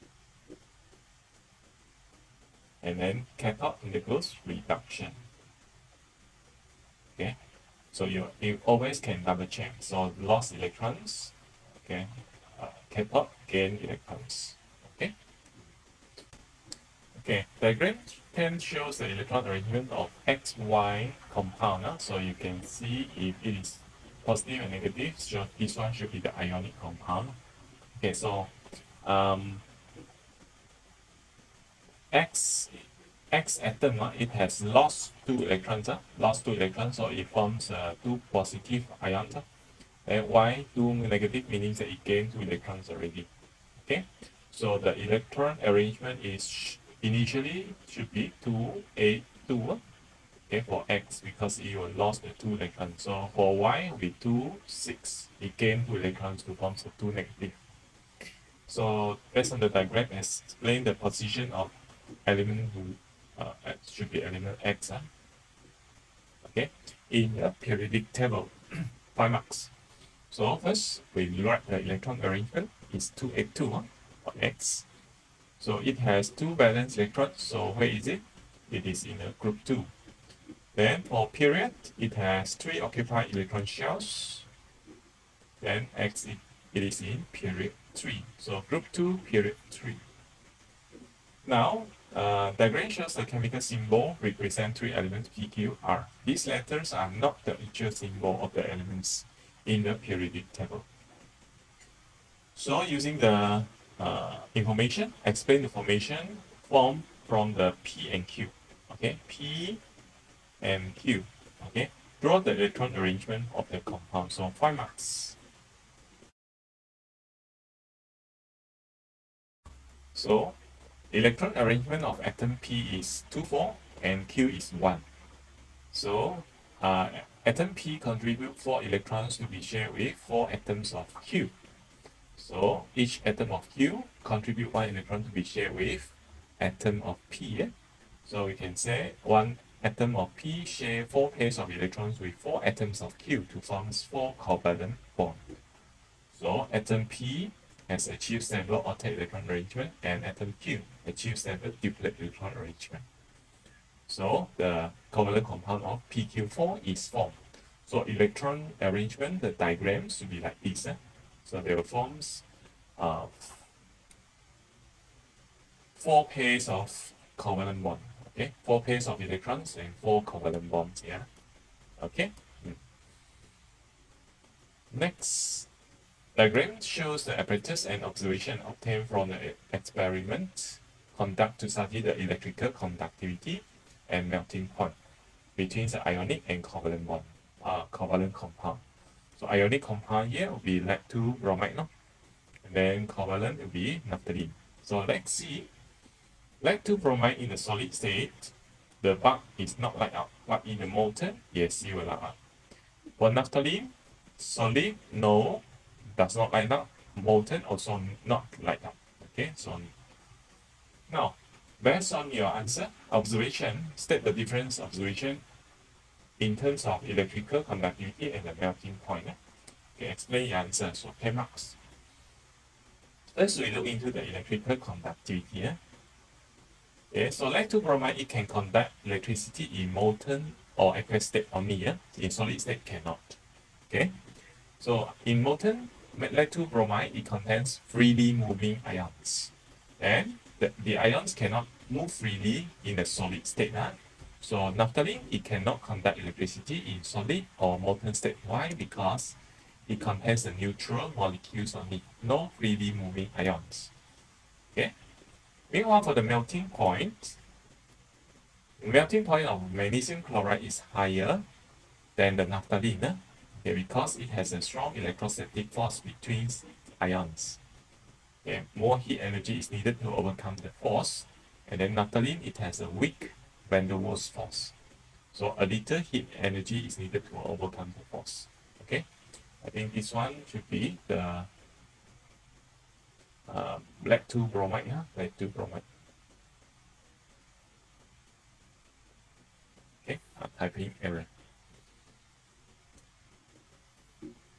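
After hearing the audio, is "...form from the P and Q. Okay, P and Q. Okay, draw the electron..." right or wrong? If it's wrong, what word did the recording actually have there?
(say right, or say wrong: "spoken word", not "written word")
right.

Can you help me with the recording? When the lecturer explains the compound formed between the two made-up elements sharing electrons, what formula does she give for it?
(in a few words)
PQ4.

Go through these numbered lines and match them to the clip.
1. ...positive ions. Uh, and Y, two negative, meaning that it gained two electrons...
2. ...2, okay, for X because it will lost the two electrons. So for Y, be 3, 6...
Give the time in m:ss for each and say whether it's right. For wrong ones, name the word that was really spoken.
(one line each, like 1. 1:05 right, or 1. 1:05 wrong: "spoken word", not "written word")
1. 0:38 right
2. 0:49 wrong: "2", not "3".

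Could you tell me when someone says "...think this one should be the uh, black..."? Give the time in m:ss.
4:39.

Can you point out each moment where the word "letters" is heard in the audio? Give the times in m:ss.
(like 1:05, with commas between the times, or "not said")
1:36.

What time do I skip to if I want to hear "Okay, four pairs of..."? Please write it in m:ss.
2:48.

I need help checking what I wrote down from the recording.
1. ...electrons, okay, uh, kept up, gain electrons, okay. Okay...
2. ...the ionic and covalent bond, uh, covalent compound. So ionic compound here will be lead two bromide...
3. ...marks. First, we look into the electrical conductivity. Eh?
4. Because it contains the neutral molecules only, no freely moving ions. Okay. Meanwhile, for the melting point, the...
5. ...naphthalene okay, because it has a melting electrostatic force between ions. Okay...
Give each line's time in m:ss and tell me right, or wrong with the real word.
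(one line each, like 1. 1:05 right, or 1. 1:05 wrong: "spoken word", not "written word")
1. 0:10 right
2. 3:05 right
3. 3:41 right
4. 4:08 right
5. 4:22 wrong: "strong", not "melting".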